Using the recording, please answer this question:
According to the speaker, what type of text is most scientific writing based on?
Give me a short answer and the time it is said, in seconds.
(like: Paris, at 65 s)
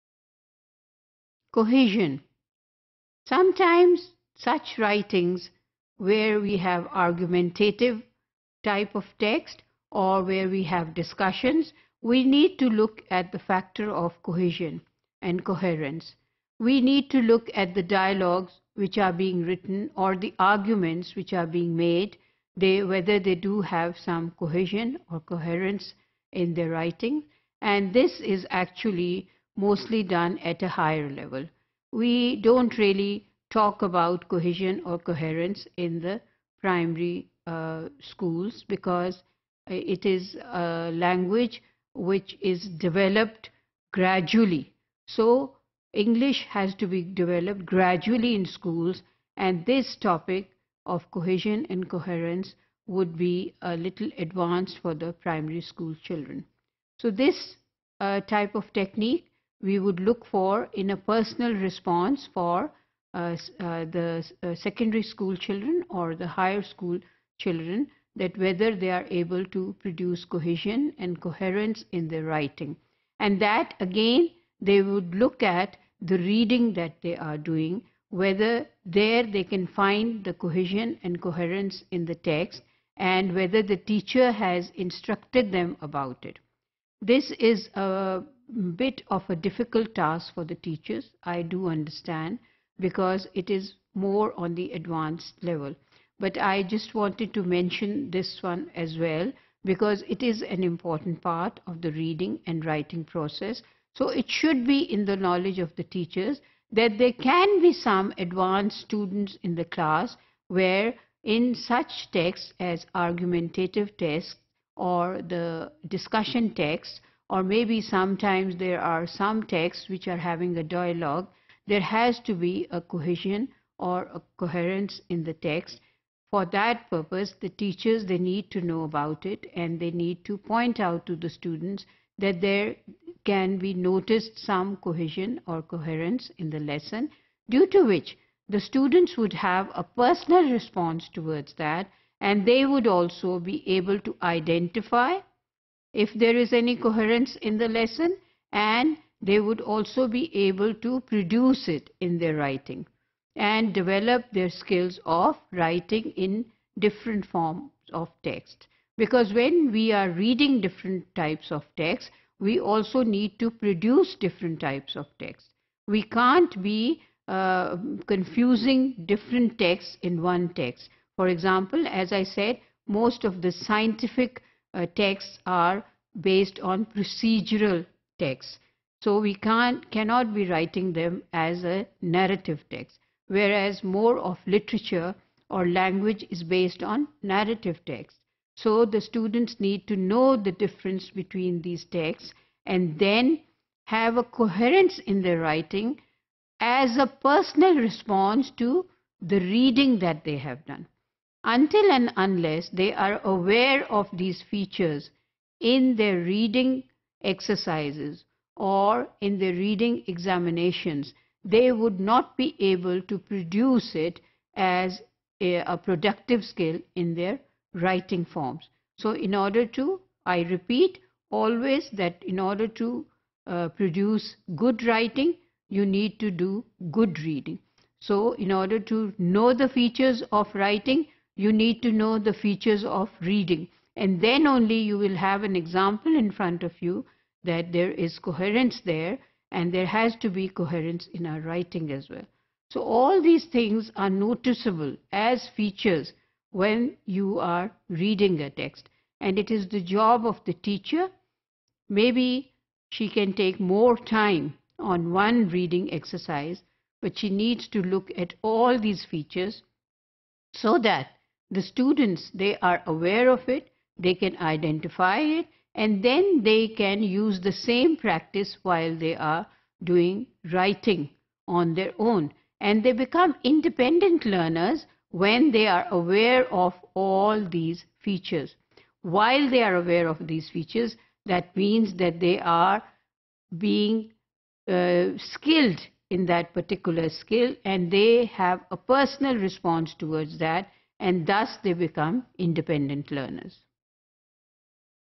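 Procedural texts, at 176 s.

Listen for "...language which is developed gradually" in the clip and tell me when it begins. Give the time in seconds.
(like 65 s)
40 s.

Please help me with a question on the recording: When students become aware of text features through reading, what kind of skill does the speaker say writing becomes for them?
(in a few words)
Productive skill.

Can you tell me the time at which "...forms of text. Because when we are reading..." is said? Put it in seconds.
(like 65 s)
157 s.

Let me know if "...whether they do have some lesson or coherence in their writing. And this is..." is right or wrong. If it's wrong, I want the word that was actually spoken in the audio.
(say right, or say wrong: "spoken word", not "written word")
wrong: "cohesion", not "lesson".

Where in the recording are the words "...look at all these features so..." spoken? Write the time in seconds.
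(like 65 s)
257 s.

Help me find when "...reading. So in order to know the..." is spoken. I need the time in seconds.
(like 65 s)
227 s.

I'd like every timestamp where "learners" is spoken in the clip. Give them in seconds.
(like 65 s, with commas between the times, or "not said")
274 s, 293 s.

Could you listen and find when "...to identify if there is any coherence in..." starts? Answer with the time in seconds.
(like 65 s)
144 s.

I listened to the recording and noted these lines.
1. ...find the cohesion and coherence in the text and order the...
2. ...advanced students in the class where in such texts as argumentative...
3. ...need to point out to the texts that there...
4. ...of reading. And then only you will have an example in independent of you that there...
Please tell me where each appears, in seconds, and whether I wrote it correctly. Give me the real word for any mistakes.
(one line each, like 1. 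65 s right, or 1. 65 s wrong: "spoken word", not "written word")
1. 79 s wrong: "whether", not "order"
2. 108 s right
3. 129 s wrong: "students", not "texts"
4. 232 s wrong: "front", not "independent".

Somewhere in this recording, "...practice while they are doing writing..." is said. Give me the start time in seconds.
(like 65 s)
267 s.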